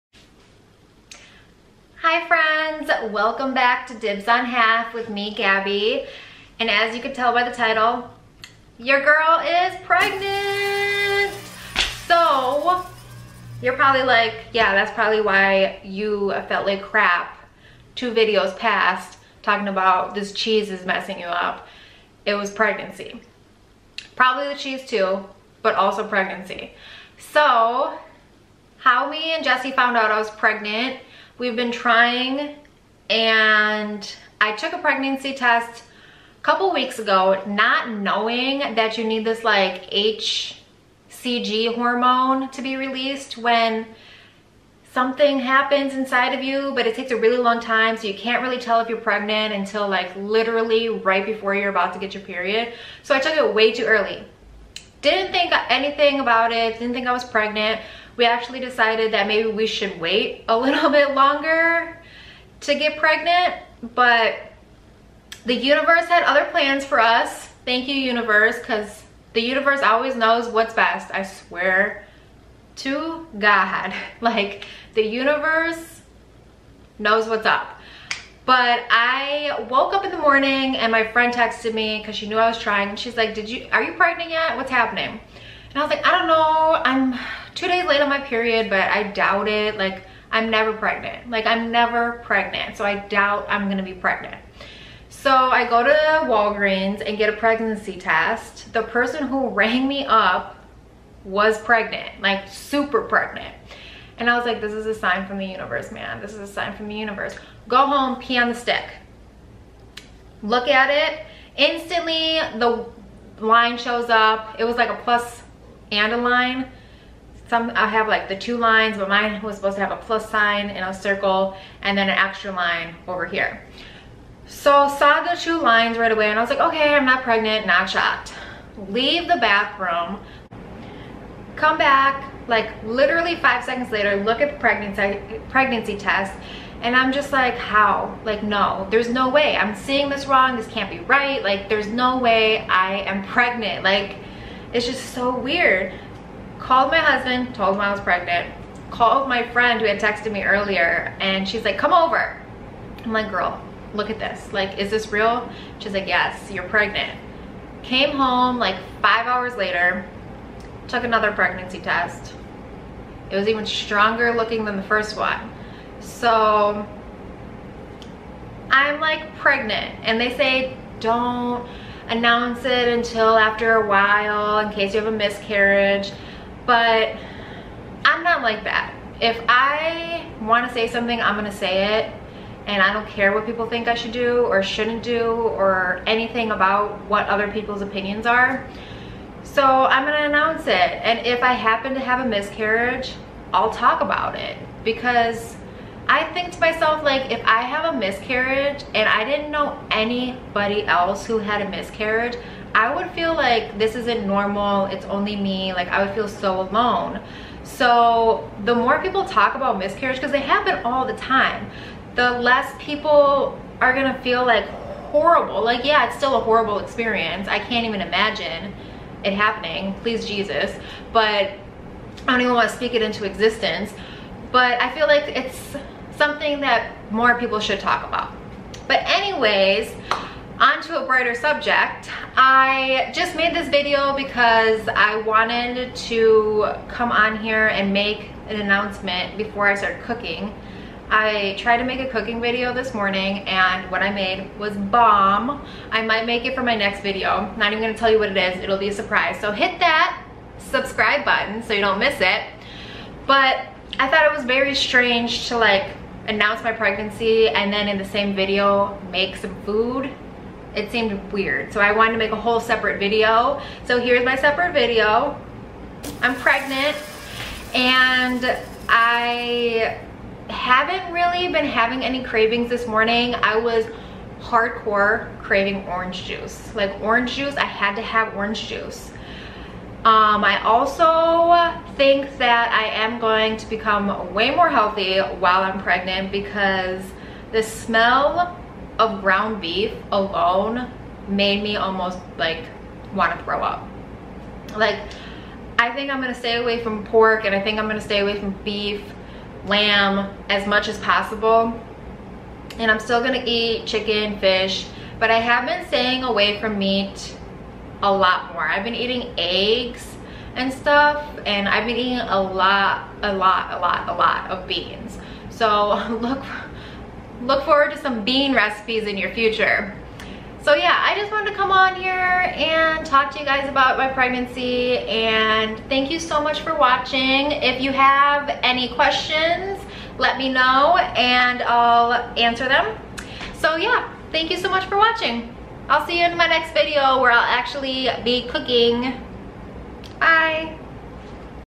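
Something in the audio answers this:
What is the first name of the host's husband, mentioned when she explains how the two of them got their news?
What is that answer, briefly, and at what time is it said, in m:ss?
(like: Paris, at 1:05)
Jesse, at 0:29.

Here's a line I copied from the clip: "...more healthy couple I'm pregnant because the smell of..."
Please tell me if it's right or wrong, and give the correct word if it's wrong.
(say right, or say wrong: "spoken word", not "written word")
wrong: "while", not "couple".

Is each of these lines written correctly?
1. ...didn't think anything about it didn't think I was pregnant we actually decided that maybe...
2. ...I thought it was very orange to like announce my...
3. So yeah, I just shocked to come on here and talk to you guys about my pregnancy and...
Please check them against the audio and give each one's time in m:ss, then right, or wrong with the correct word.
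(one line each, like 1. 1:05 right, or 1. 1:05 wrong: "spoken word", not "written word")
1. 0:55 right
2. 4:13 wrong: "strange", not "orange"
3. 5:20 wrong: "wanted", not "shocked".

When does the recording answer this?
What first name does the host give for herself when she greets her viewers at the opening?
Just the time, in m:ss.
0:05.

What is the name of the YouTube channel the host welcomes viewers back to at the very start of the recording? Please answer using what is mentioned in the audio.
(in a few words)
Dibs on Half.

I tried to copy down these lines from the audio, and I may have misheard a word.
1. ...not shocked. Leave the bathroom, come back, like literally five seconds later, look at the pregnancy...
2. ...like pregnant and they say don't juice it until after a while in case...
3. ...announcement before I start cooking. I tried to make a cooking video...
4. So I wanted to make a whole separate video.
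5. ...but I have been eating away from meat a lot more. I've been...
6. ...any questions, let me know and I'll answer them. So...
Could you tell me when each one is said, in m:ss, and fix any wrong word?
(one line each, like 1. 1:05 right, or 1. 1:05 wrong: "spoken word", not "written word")
1. 2:07 right
2. 2:48 wrong: "announce", not "juice"
3. 3:58 right
4. 4:21 right
5. 5:05 wrong: "staying", not "eating"
6. 5:28 right.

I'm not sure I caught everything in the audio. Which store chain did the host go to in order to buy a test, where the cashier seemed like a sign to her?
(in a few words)
Walgreens.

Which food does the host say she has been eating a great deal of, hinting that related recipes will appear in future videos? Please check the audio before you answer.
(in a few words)
Beans.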